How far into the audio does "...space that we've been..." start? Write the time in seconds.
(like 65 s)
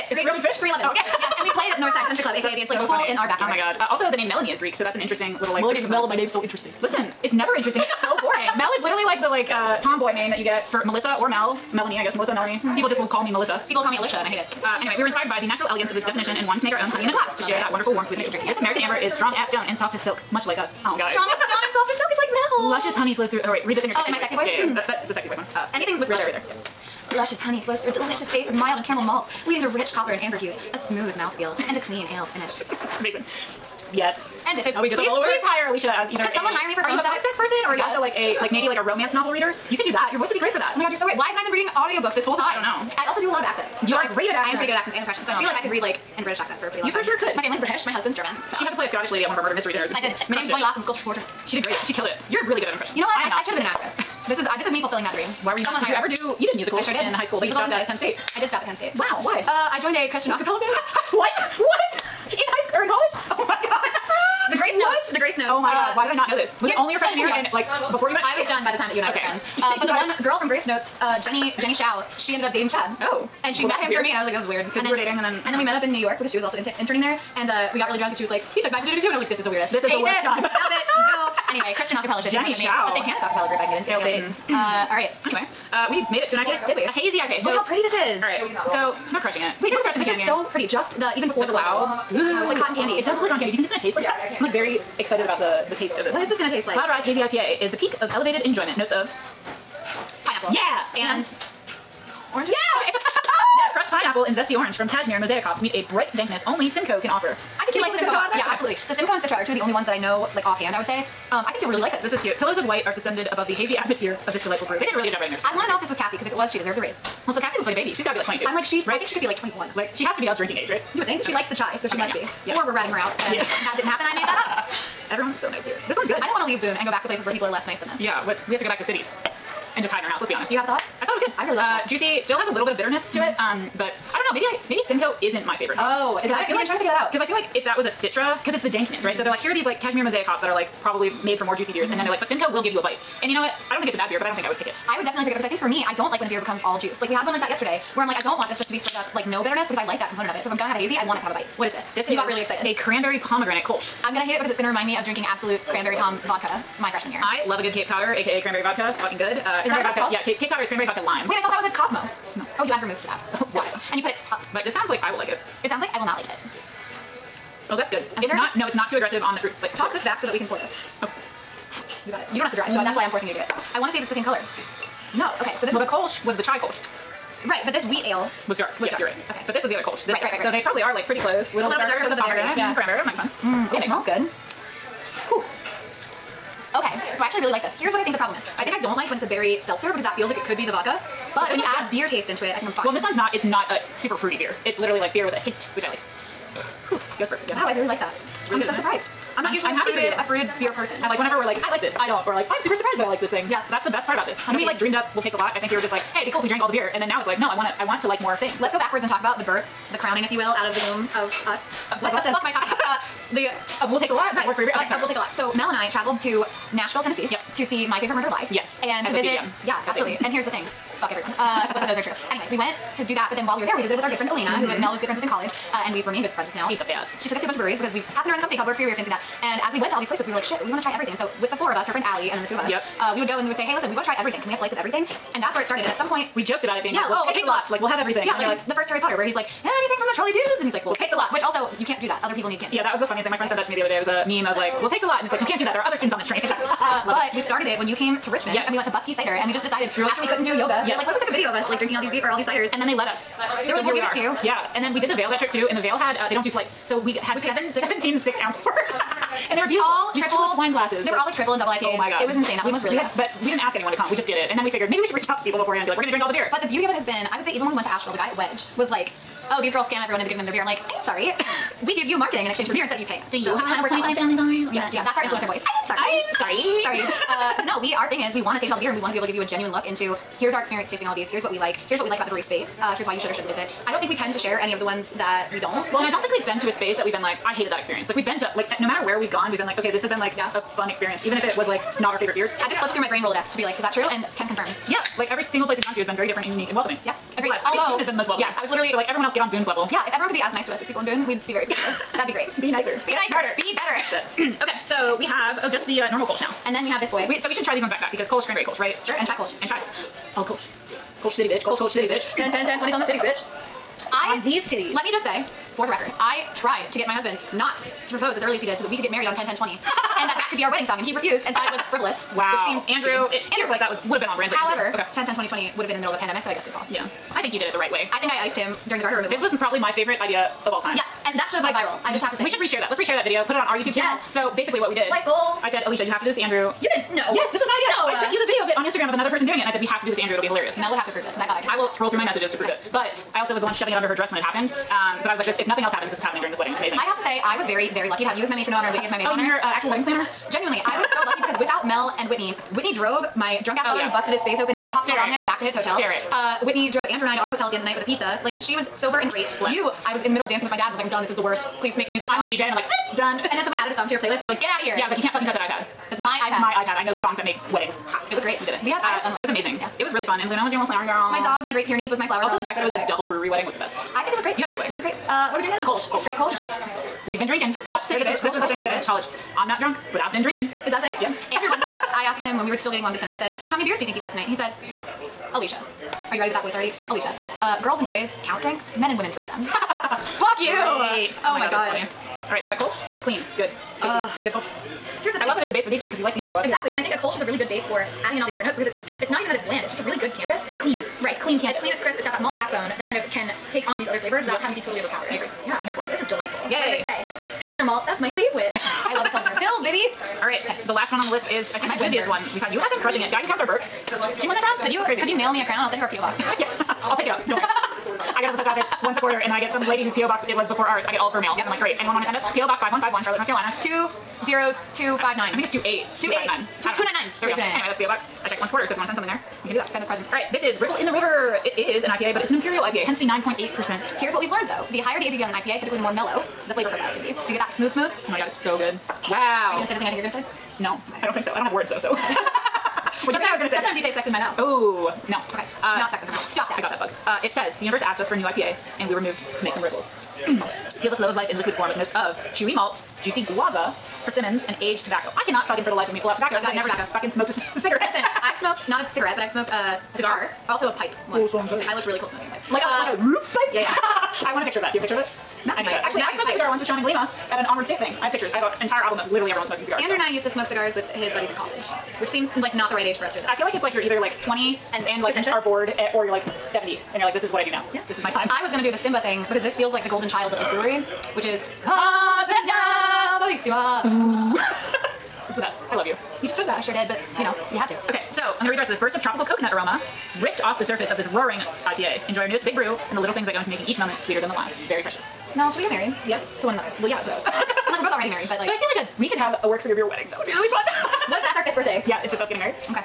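286 s.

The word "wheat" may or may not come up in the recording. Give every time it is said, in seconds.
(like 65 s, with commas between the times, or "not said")
177 s.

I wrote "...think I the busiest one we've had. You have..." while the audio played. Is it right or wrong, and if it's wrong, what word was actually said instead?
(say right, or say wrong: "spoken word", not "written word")
right.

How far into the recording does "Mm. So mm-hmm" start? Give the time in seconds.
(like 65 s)
139 s.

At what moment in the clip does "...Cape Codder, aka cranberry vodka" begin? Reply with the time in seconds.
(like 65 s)
157 s.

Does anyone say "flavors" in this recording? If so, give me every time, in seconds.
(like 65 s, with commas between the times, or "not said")
169 s, 404 s, 436 s.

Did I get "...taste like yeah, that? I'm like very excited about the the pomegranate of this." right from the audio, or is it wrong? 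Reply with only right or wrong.
wrong.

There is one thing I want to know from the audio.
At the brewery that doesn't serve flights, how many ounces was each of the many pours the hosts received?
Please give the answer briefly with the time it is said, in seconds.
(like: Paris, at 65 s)
6 ounces, at 258 s.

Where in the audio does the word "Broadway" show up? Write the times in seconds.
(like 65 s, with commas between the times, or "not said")
not said.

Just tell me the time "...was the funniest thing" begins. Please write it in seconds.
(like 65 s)
242 s.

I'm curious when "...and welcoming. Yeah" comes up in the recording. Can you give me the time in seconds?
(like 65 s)
296 s.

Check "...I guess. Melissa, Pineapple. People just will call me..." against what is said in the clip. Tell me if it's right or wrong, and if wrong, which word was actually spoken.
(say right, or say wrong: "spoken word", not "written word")
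wrong: "Melanie", not "Pineapple".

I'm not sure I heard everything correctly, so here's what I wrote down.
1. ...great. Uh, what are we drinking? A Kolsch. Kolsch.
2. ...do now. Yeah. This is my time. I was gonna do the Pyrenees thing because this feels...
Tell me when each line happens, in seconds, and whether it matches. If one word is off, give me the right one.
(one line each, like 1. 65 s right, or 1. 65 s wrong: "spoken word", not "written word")
1. 375 s right
2. 477 s wrong: "Simba", not "Pyrenees".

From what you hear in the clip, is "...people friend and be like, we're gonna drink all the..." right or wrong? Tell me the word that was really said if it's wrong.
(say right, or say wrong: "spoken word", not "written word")
wrong: "beforehand", not "friend".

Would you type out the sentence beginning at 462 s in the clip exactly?
Like a uh, like a whoops pipe?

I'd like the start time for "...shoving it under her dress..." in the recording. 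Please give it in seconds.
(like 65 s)
343 s.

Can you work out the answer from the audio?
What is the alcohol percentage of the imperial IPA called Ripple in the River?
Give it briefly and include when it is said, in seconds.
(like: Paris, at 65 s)
9.8%, at 433 s.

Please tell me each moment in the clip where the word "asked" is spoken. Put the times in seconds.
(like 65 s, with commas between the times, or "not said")
382 s, 448 s.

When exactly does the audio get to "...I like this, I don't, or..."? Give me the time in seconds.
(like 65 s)
201 s.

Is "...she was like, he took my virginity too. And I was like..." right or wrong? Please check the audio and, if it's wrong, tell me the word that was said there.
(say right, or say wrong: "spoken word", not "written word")
right.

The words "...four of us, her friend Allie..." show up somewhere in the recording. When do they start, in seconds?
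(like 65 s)
231 s.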